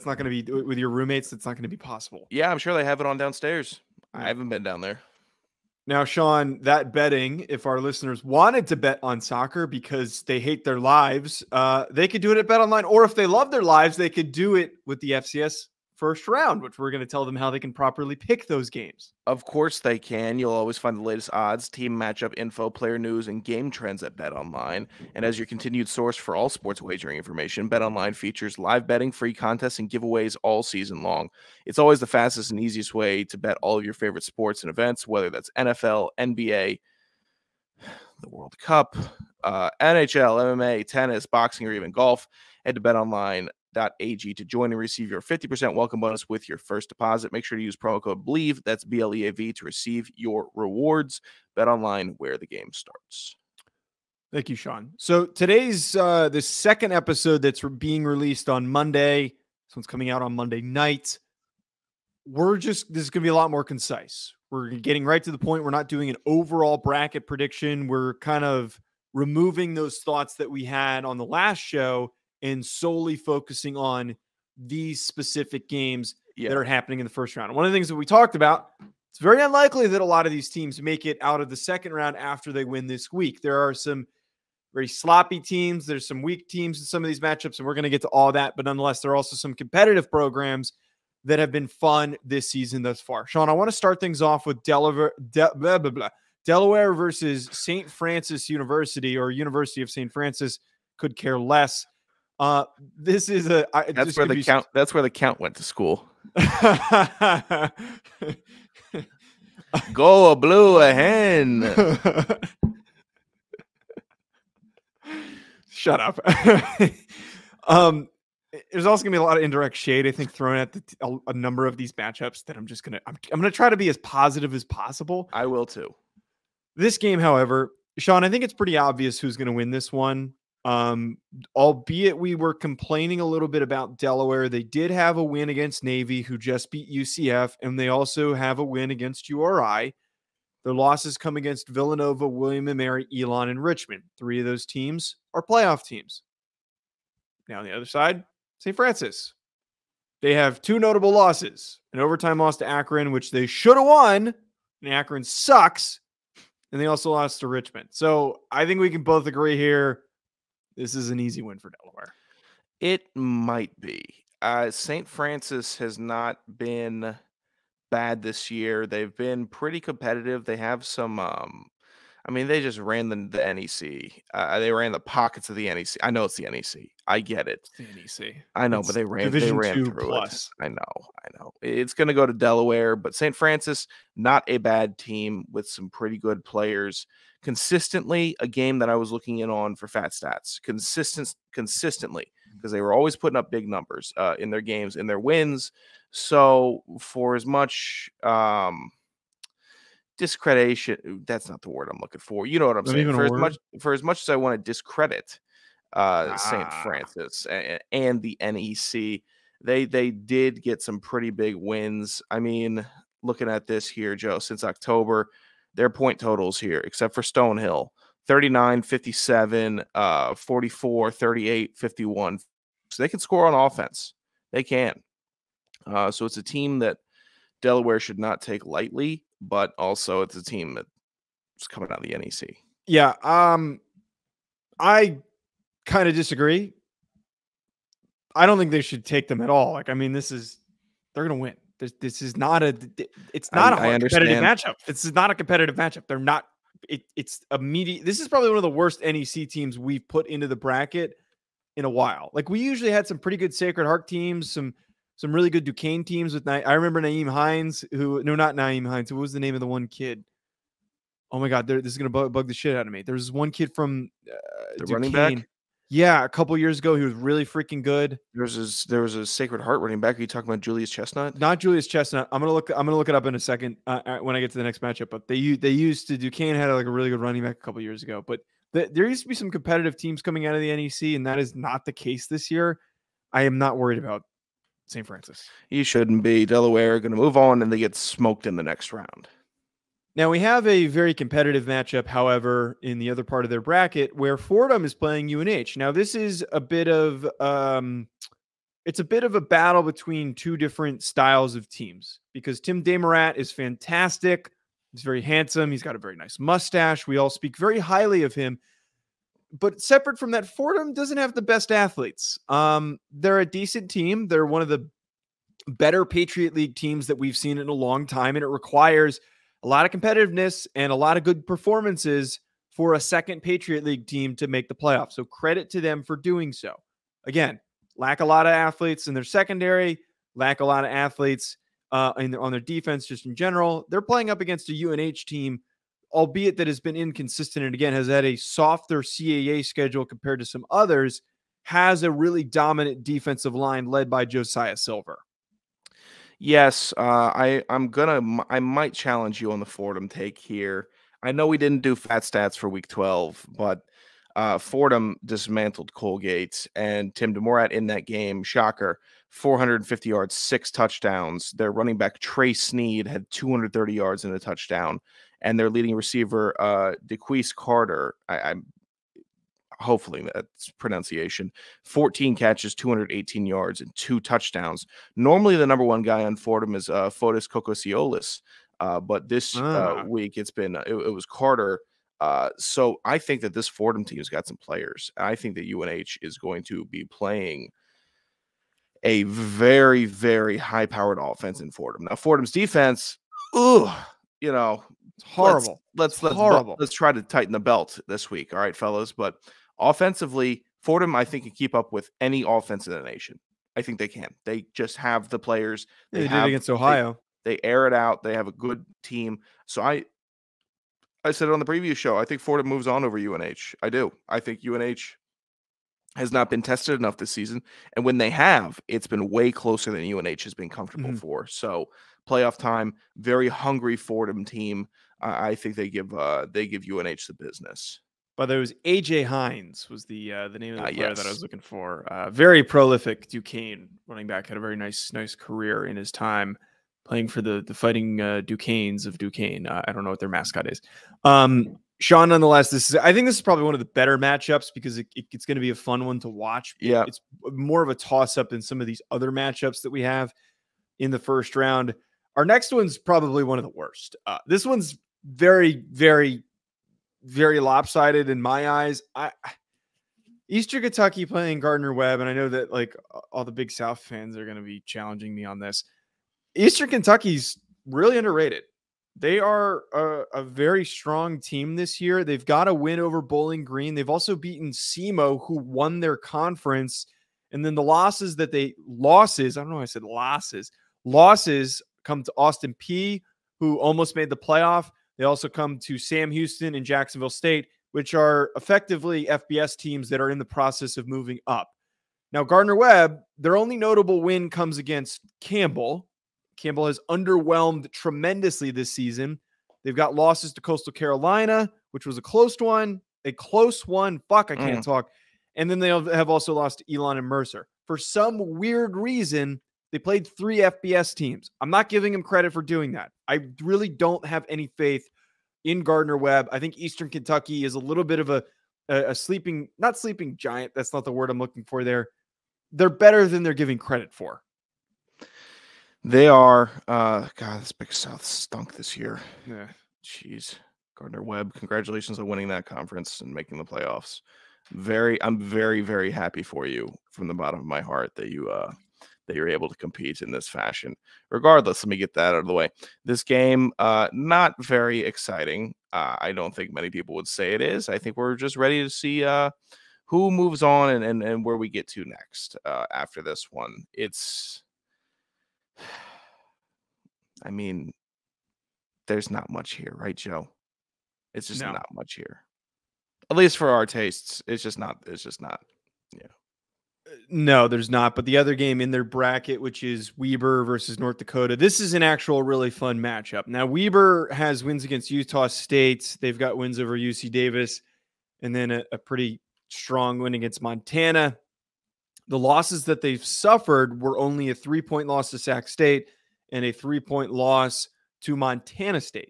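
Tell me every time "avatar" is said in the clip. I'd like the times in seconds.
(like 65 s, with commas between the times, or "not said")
not said.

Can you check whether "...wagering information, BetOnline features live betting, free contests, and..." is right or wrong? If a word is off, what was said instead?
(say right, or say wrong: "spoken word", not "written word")
right.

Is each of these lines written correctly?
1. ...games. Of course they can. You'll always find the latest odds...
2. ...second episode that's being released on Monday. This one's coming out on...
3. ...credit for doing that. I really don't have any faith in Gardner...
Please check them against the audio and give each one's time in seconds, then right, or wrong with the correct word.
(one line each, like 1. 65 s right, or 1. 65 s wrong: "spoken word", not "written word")
1. 18 s right
2. 56 s right
3. 512 s right.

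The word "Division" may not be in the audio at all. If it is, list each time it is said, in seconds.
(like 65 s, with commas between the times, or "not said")
179 s.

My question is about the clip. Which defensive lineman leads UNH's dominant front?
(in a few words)
Josiah Silver.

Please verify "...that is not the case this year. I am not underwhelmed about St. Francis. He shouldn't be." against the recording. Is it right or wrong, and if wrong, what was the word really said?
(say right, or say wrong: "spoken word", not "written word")
wrong: "worried", not "underwhelmed".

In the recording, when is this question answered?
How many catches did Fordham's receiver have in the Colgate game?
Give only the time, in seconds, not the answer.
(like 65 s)
371 s.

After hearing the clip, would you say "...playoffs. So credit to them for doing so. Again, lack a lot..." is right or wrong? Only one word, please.
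right.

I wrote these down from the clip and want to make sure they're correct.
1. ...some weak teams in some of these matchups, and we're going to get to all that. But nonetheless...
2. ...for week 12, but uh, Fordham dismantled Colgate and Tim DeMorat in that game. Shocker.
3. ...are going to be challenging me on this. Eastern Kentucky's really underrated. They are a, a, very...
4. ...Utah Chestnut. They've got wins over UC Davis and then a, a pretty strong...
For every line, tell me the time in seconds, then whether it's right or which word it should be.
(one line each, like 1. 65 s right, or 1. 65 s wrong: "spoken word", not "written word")
1. 86 s right
2. 352 s right
3. 464 s right
4. 575 s wrong: "State", not "Chestnut".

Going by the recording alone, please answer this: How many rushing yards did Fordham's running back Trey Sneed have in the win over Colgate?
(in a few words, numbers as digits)
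230.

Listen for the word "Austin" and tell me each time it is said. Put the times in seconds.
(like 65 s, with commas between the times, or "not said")
482 s.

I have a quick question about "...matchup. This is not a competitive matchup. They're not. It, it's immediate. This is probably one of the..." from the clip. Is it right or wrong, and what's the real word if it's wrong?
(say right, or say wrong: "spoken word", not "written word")
right.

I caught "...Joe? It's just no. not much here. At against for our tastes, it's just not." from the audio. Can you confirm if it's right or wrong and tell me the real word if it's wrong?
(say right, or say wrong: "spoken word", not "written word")
wrong: "least", not "against".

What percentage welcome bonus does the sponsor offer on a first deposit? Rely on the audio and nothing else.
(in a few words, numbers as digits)
50%.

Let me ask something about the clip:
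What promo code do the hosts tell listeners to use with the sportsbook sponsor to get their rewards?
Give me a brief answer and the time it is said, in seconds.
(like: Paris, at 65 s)
BELIEVE, at 48 s.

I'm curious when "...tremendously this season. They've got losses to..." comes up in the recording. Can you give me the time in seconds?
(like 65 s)
497 s.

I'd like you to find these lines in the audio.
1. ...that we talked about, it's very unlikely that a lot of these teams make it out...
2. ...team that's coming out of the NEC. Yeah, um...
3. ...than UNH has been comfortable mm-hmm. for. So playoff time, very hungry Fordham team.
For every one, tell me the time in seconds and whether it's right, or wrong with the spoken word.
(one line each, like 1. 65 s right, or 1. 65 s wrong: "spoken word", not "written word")
1. 77 s right
2. 230 s right
3. 419 s right.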